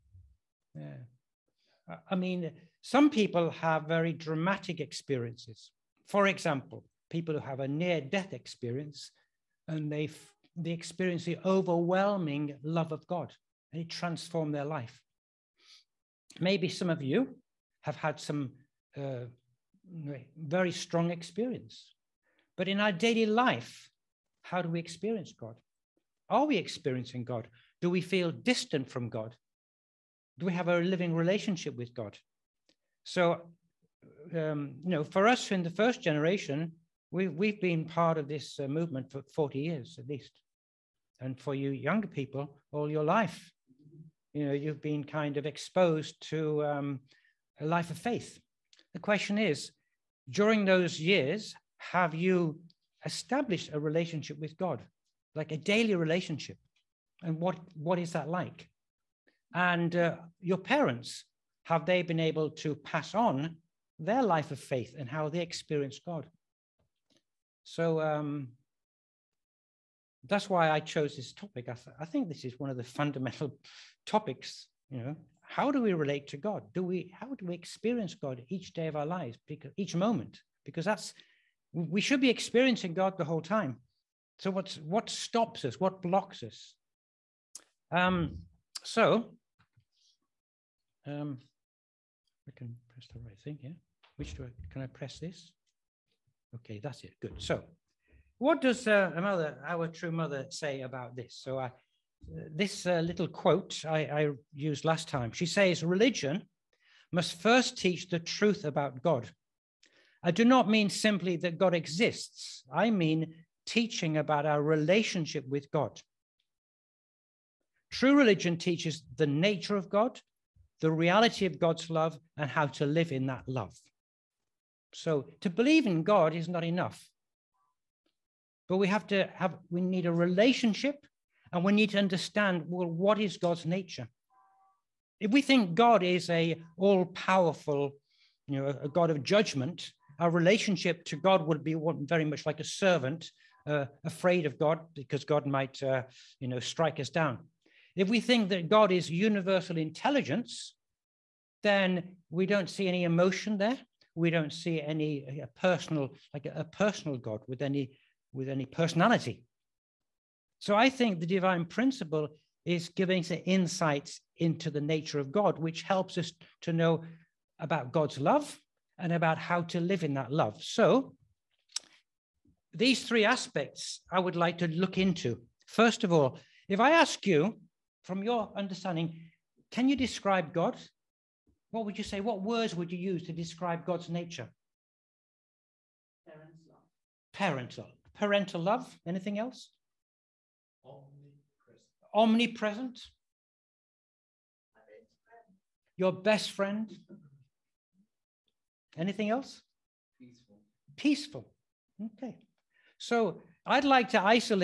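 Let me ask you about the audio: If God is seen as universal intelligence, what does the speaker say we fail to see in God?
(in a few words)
emotion.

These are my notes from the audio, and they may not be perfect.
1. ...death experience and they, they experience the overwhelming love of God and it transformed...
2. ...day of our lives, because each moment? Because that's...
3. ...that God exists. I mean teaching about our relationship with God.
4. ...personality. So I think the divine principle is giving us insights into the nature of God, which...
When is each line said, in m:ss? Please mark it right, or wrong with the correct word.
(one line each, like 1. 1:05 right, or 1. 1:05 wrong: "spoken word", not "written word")
1. 0:07 right
2. 1:18 right
3. 1:51 right
4. 2:38 right.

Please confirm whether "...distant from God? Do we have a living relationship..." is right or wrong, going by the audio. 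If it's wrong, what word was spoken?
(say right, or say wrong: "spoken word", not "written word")
right.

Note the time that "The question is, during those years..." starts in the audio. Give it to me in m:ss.
0:48.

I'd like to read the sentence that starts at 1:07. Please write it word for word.
So um, that's why I chose this topic.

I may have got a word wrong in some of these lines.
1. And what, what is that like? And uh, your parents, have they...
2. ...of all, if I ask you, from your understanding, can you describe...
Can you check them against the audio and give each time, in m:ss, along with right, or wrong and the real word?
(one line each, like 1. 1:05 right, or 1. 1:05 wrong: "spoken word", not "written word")
1. 0:57 right
2. 2:56 right.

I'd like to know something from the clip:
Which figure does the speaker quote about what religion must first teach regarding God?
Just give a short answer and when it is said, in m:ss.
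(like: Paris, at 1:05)
True Mother, at 1:39.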